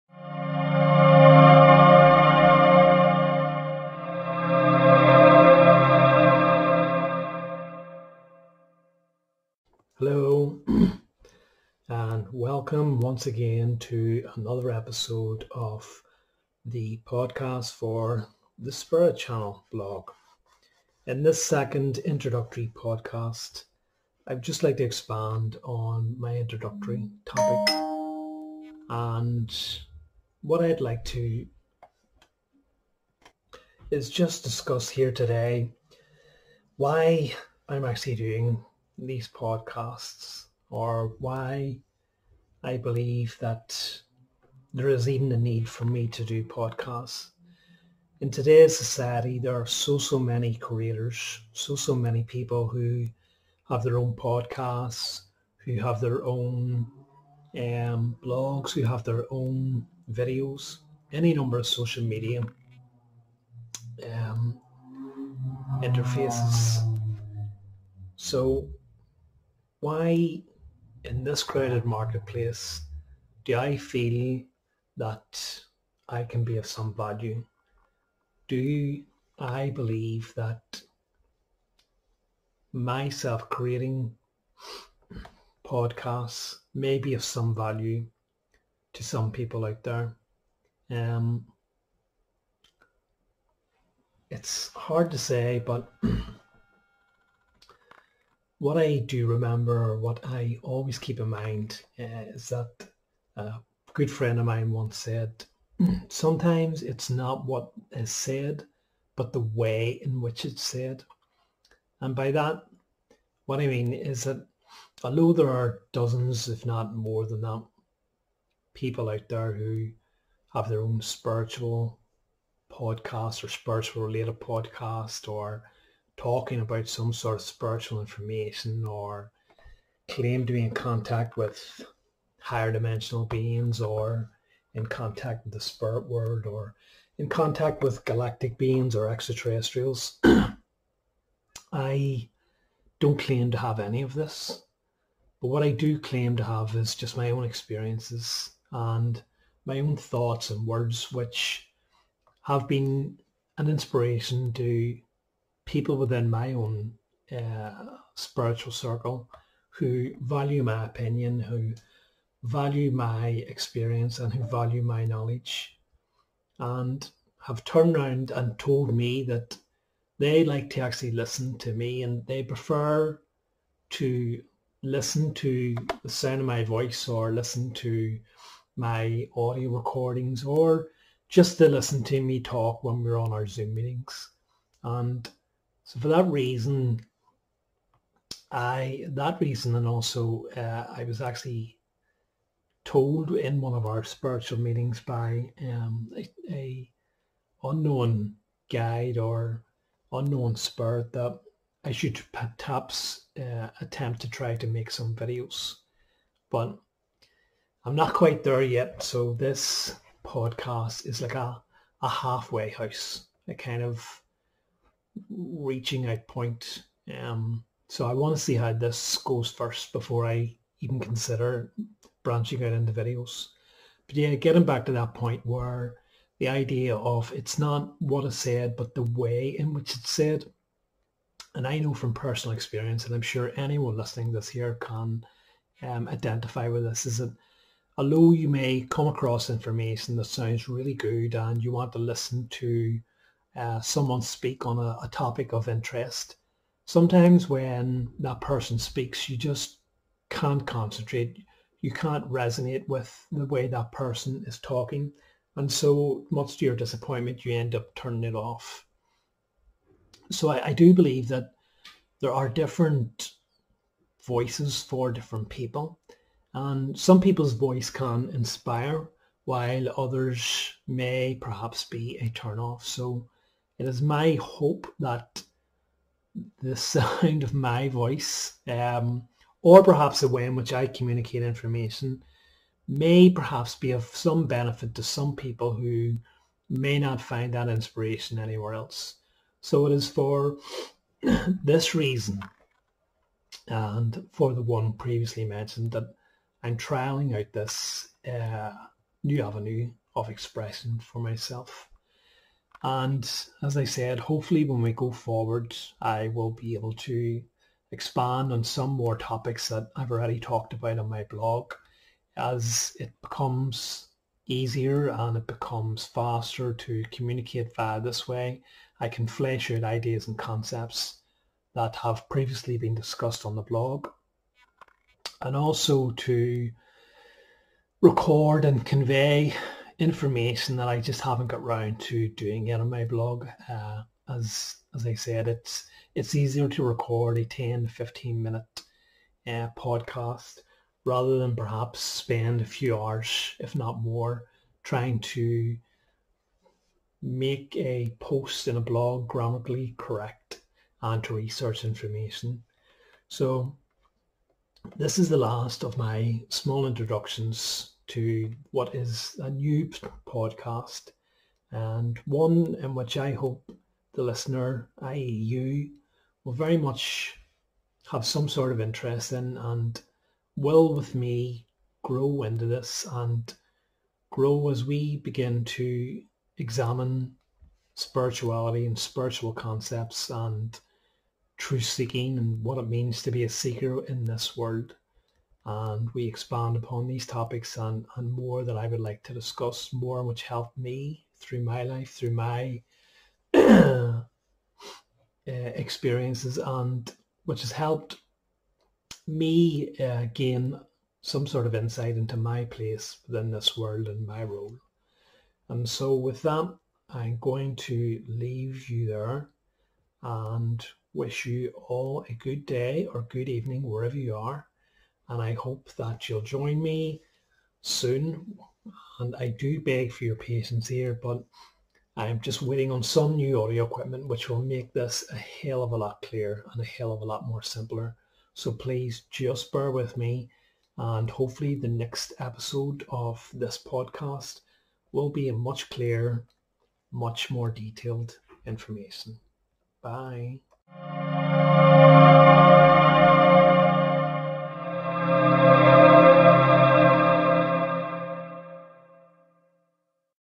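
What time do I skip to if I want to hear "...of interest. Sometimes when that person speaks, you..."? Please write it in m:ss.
4:05.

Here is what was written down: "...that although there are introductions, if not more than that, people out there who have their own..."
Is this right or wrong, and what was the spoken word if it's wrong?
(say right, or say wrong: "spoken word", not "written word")
wrong: "dozens", not "introductions".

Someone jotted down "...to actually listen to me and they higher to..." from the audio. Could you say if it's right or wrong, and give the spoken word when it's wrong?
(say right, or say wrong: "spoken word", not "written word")
wrong: "prefer", not "higher".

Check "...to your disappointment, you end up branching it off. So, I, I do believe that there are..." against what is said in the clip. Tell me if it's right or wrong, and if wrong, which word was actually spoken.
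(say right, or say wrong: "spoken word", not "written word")
wrong: "turning", not "branching".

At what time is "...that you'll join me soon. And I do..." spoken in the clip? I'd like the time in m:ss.
6:55.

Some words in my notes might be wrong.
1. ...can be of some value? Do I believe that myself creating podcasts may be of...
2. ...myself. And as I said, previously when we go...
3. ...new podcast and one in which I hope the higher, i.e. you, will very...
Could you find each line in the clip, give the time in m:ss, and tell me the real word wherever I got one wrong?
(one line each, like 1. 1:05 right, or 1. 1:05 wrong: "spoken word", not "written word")
1. 1:16 right
2. 5:01 wrong: "hopefully", not "previously"
3. 5:59 wrong: "listener", not "higher".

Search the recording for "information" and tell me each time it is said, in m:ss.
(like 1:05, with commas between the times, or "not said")
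2:07, 3:59, 4:41, 5:30, 5:51, 7:18.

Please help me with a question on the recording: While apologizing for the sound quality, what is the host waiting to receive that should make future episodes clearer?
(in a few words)
new audio equipment.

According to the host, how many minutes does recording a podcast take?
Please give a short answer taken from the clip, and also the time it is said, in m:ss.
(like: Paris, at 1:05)
10 15 minutes, at 5:37.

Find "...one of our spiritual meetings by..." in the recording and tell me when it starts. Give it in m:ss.
3:13.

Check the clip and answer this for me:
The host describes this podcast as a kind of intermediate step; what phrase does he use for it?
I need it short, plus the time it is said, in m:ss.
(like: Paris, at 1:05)
halfway house, at 3:32.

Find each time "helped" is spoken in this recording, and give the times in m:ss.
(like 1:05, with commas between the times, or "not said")
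6:30, 6:37.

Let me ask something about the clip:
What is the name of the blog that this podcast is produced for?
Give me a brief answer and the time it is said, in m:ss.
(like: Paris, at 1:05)
Spirit Channel, at 0:18.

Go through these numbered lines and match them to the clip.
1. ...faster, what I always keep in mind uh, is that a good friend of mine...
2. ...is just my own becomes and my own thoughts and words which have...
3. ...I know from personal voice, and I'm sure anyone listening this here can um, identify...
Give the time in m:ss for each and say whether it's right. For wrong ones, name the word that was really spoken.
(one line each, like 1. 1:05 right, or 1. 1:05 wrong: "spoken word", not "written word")
1. 1:39 wrong: "remember", not "faster"
2. 2:26 wrong: "experiences", not "becomes"
3. 3:51 wrong: "experience", not "voice".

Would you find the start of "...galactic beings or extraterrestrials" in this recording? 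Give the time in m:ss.
2:18.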